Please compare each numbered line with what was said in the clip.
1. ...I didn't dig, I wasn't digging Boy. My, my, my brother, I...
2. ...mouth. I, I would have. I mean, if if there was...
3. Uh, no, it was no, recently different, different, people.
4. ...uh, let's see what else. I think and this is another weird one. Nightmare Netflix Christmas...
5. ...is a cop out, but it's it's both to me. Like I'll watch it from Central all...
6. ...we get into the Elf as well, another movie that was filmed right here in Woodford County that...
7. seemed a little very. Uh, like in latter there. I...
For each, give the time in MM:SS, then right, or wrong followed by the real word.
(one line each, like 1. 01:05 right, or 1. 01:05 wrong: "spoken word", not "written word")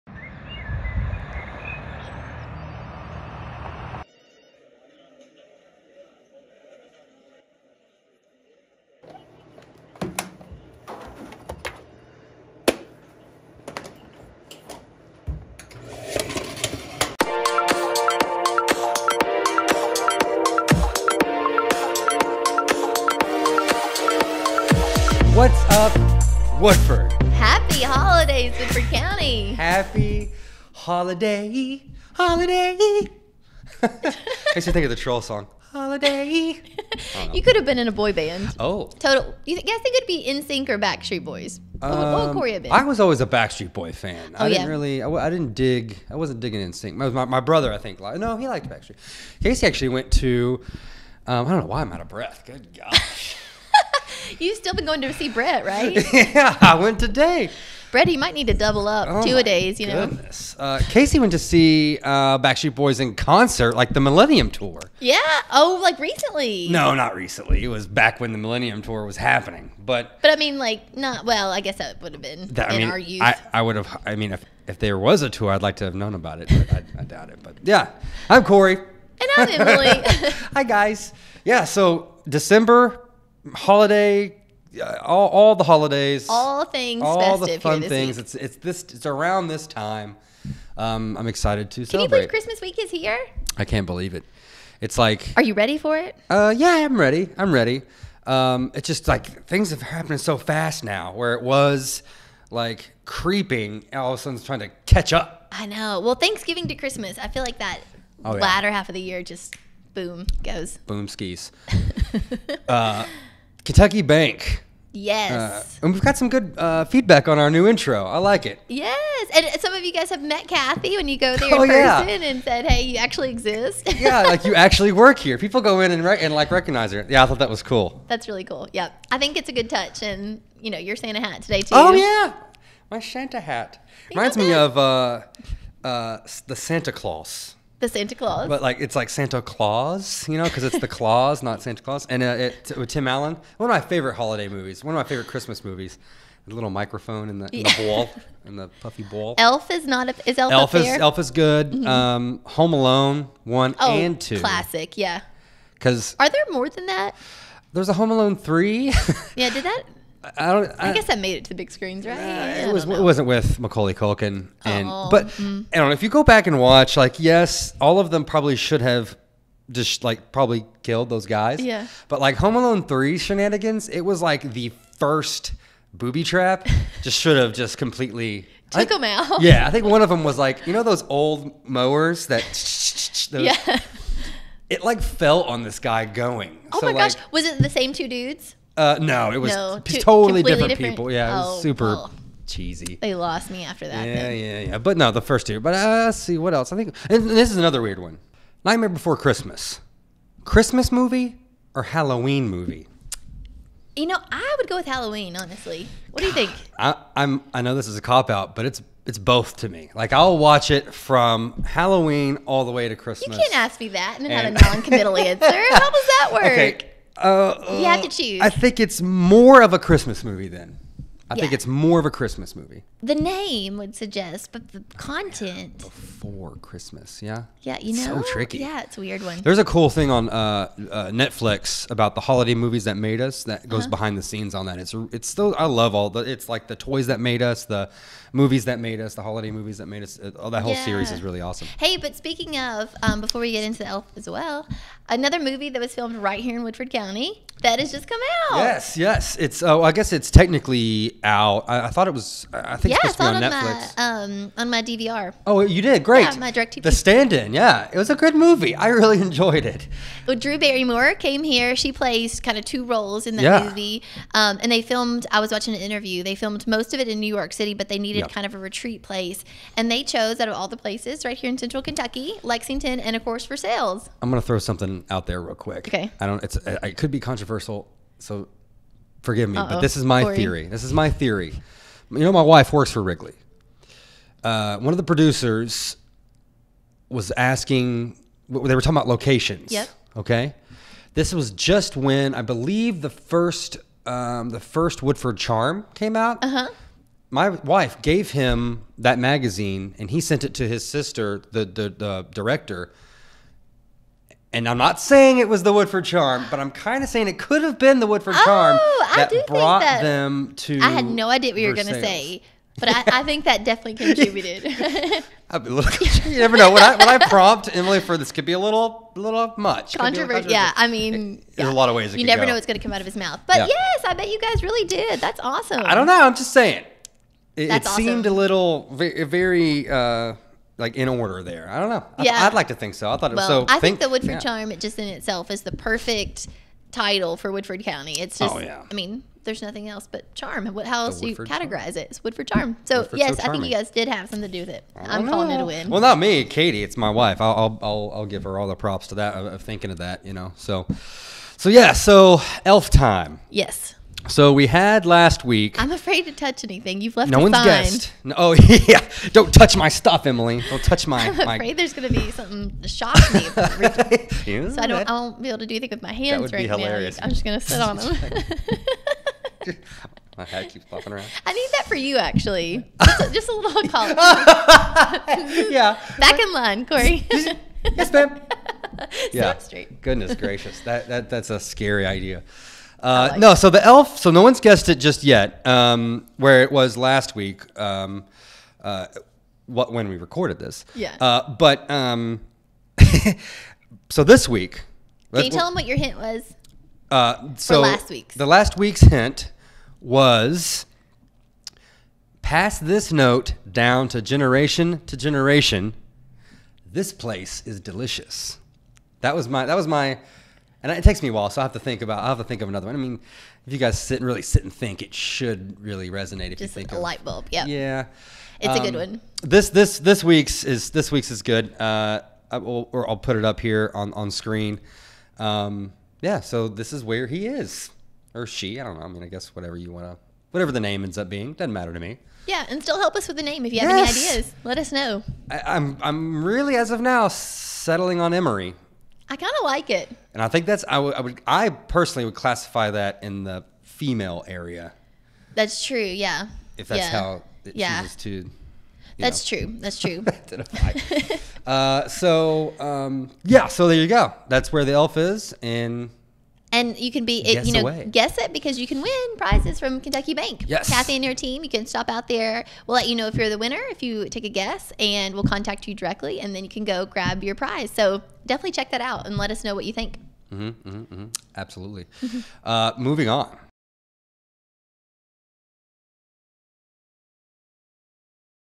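1. 00:45 wrong: "NSYNC", not "Boy"
2. 01:12 wrong: "youth", not "mouth"
3. 03:08 wrong: "totally", not "recently"
4. 03:15 wrong: "Before", not "Netflix"
5. 03:27 wrong: "Halloween", not "Central"
6. 04:03 right
7. 05:28 wrong: "order", not "latter".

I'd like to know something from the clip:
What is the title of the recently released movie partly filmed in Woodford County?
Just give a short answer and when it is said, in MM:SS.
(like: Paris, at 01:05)
The Stand-in, at 04:16.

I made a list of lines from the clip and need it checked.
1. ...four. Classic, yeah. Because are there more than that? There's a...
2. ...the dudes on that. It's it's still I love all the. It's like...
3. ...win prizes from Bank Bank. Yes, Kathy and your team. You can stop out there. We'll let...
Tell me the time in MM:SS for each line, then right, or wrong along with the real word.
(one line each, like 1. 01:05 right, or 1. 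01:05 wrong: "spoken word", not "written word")
1. 02:34 wrong: "two", not "four"
2. 03:54 wrong: "scenes", not "dudes"
3. 07:39 wrong: "Kentucky", not "Bank".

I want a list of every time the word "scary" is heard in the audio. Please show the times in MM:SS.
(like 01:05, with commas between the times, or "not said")
06:21.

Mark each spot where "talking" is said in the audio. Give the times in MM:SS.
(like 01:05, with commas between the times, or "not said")
04:48.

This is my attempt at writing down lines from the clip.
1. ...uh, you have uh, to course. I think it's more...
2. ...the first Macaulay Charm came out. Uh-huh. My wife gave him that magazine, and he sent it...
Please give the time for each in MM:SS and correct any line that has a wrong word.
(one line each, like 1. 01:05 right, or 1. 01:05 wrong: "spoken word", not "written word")
1. 03:37 wrong: "choose", not "course"
2. 04:54 wrong: "Woodford", not "Macaulay".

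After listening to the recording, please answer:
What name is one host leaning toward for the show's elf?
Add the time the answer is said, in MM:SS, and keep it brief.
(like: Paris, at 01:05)
Emory, at 07:18.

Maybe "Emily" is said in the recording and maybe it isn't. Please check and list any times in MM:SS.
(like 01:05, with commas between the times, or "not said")
01:19, 05:17, 06:00.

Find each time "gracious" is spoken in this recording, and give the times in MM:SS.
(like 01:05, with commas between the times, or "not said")
06:20.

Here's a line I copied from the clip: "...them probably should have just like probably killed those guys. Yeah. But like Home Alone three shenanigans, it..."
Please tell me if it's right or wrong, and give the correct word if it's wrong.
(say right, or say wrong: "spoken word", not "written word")
right.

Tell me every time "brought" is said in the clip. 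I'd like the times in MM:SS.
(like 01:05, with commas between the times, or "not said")
05:09.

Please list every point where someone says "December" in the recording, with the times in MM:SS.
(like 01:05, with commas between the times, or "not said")
01:22.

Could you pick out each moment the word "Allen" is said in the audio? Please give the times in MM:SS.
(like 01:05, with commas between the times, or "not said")
02:23.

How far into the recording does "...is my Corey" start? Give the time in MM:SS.
04:39.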